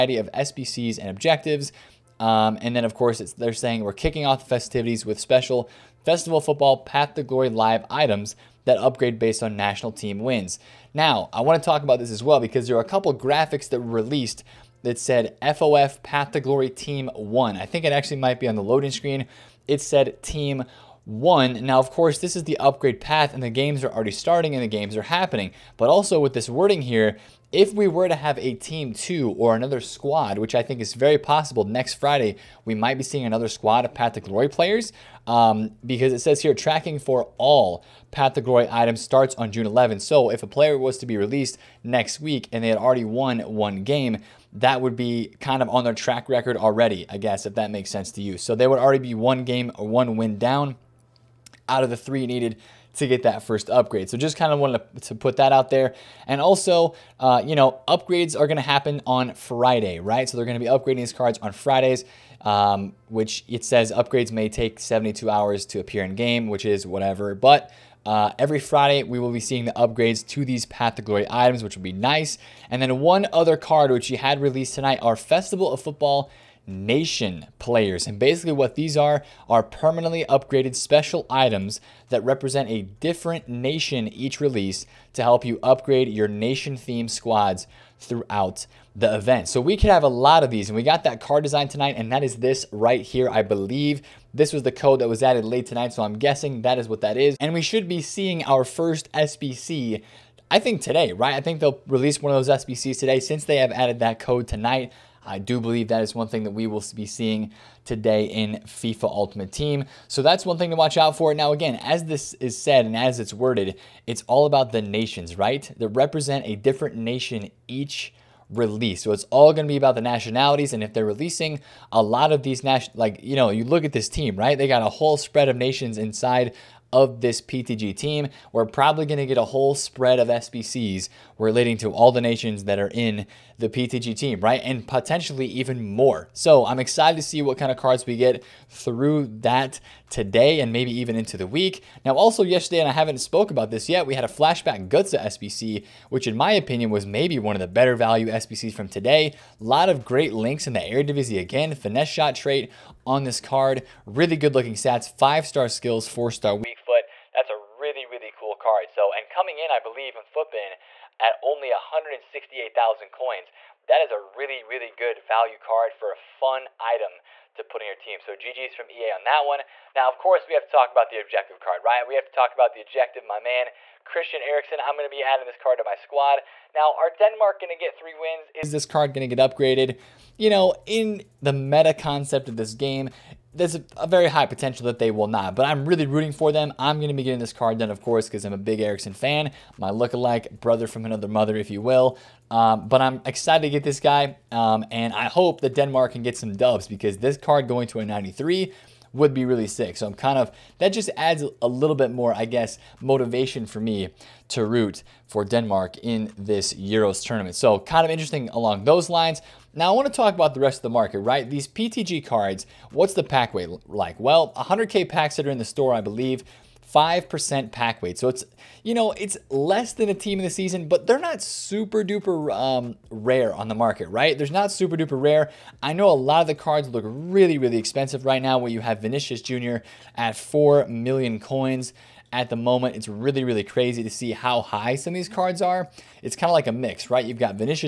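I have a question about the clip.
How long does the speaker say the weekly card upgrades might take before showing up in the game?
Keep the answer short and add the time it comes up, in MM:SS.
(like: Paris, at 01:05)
72 hours, at 01:04.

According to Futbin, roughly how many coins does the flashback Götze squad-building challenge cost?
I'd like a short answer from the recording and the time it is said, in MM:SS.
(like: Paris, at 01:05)
168,000, at 02:41.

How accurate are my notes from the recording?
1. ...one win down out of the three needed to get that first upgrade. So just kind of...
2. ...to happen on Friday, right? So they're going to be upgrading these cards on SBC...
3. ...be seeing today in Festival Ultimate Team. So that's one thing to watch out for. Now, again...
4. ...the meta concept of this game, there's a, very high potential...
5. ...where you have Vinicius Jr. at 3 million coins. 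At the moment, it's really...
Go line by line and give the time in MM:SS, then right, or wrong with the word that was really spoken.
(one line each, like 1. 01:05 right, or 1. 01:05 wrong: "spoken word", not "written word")
1. 00:49 right
2. 00:58 wrong: "Fridays", not "SBC"
3. 01:46 wrong: "FIFA", not "Festival"
4. 03:01 right
5. 03:48 wrong: "4", not "3".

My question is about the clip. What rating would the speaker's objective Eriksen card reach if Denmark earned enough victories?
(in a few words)
93.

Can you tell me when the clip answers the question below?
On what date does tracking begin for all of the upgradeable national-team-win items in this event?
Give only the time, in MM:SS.
00:39.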